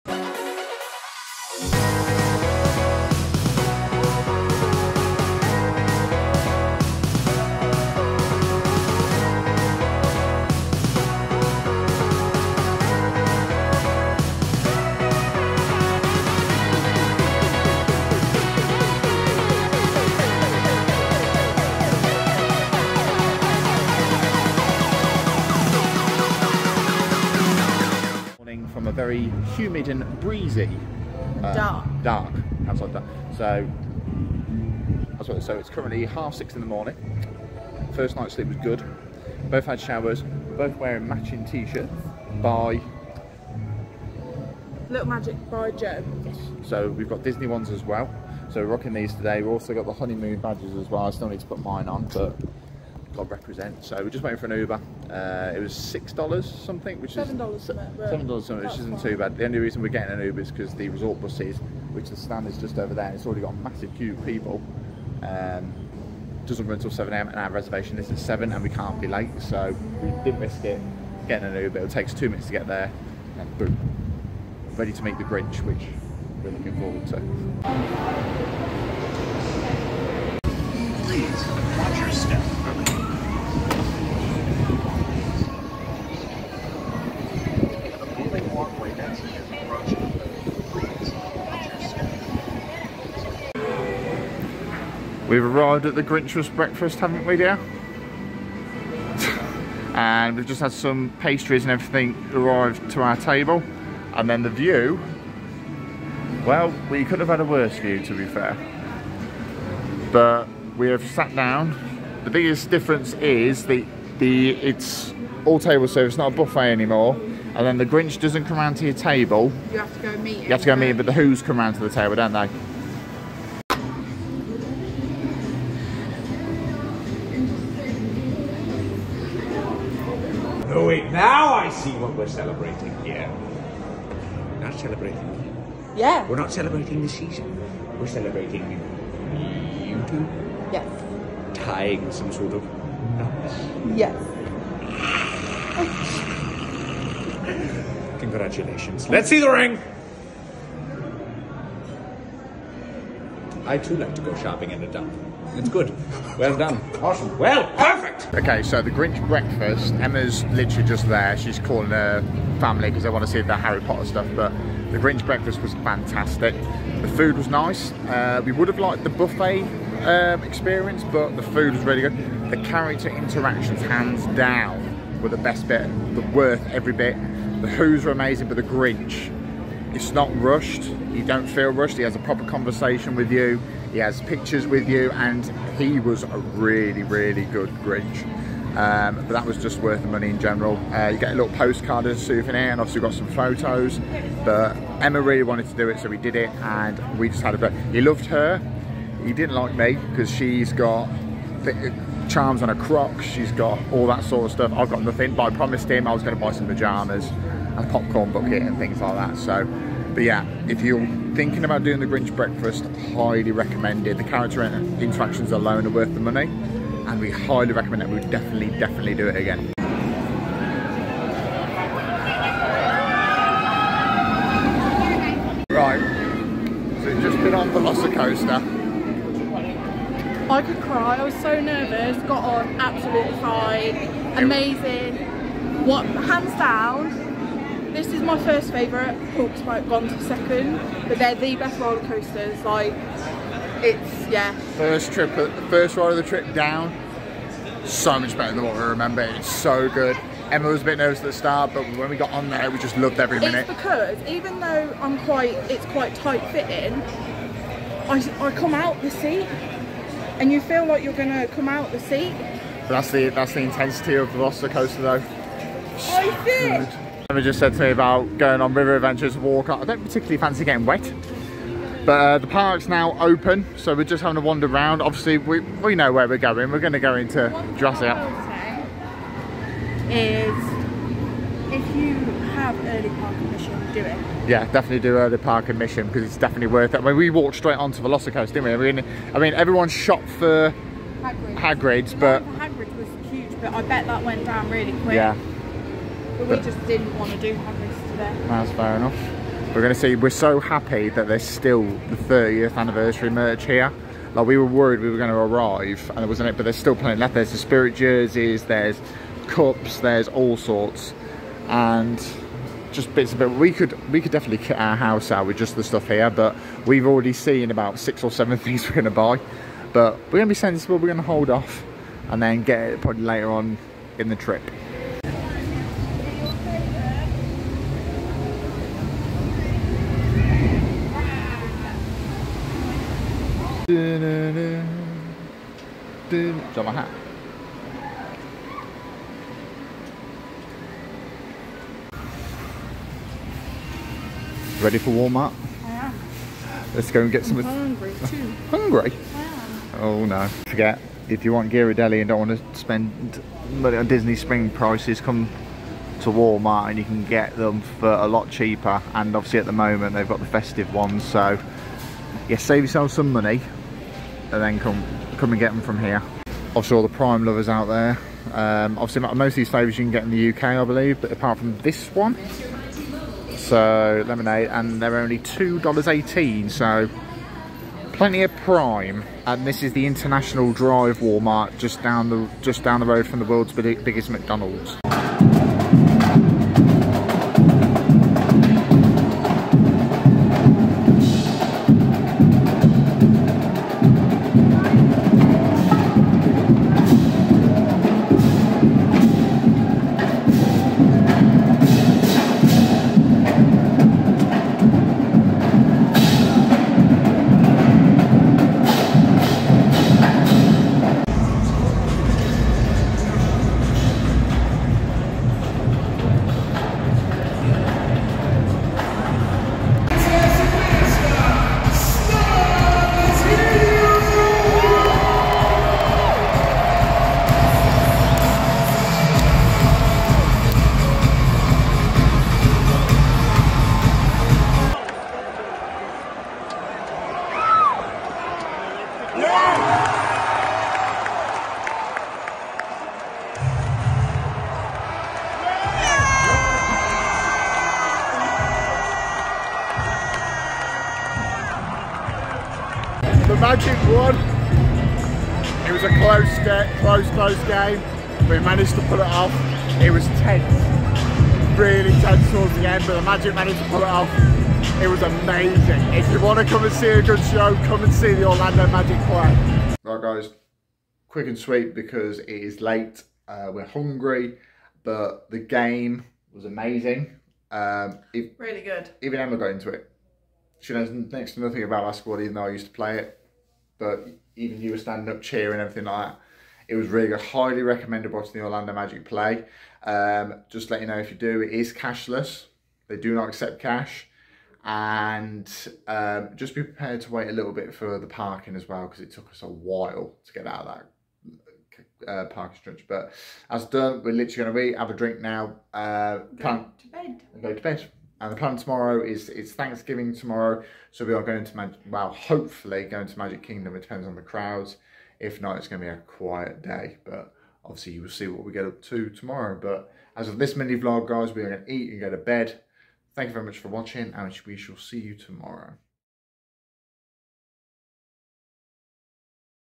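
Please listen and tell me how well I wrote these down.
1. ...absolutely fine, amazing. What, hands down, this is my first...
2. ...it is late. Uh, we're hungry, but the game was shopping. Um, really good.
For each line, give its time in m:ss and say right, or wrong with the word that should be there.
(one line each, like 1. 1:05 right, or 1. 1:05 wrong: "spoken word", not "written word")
1. 3:52 right
2. 7:52 wrong: "amazing", not "shopping".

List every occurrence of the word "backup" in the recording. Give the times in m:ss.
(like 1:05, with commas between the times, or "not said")
not said.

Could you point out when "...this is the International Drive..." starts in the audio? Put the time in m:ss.
6:19.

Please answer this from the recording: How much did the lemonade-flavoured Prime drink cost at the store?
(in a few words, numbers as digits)
$2.18.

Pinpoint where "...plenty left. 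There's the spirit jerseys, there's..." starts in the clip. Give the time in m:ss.
5:06.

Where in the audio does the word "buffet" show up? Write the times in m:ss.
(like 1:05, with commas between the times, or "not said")
1:56, 2:49.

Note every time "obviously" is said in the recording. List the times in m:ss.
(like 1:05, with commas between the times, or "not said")
3:12, 4:35, 5:59, 6:08, 8:37.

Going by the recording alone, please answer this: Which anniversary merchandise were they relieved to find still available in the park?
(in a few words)
30th anniversary.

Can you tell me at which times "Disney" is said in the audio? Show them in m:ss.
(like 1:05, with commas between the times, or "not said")
0:47, 5:54.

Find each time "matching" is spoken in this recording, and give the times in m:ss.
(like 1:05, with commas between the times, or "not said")
0:41.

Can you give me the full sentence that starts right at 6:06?
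all the prime lovers out there.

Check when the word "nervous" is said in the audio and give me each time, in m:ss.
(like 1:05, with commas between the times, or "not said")
3:51, 4:10.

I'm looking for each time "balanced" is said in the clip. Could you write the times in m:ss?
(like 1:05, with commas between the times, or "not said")
not said.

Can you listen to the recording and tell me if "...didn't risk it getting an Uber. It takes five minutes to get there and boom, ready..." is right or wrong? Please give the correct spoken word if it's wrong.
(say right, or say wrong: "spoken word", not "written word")
wrong: "two", not "five".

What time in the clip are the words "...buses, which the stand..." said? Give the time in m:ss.
1:01.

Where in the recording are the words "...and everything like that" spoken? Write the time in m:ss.
8:05.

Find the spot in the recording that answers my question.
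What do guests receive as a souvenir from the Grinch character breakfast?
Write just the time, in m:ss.
3:11.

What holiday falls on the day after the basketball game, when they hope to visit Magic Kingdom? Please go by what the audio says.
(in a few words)
Thanksgiving.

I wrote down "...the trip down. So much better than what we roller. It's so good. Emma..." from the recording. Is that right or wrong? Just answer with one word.
wrong.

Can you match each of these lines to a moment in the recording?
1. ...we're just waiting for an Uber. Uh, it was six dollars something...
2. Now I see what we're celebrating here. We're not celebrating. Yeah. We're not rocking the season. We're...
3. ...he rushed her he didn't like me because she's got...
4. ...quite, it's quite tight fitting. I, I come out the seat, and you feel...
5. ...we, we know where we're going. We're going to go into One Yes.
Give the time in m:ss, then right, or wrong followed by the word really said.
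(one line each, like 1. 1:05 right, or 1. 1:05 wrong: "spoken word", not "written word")
1. 0:54 right
2. 2:11 wrong: "celebrating", not "rocking"
3. 3:17 wrong: "loved", not "rushed"
4. 4:15 right
5. 4:35 wrong: "Jurassic", not "Yes".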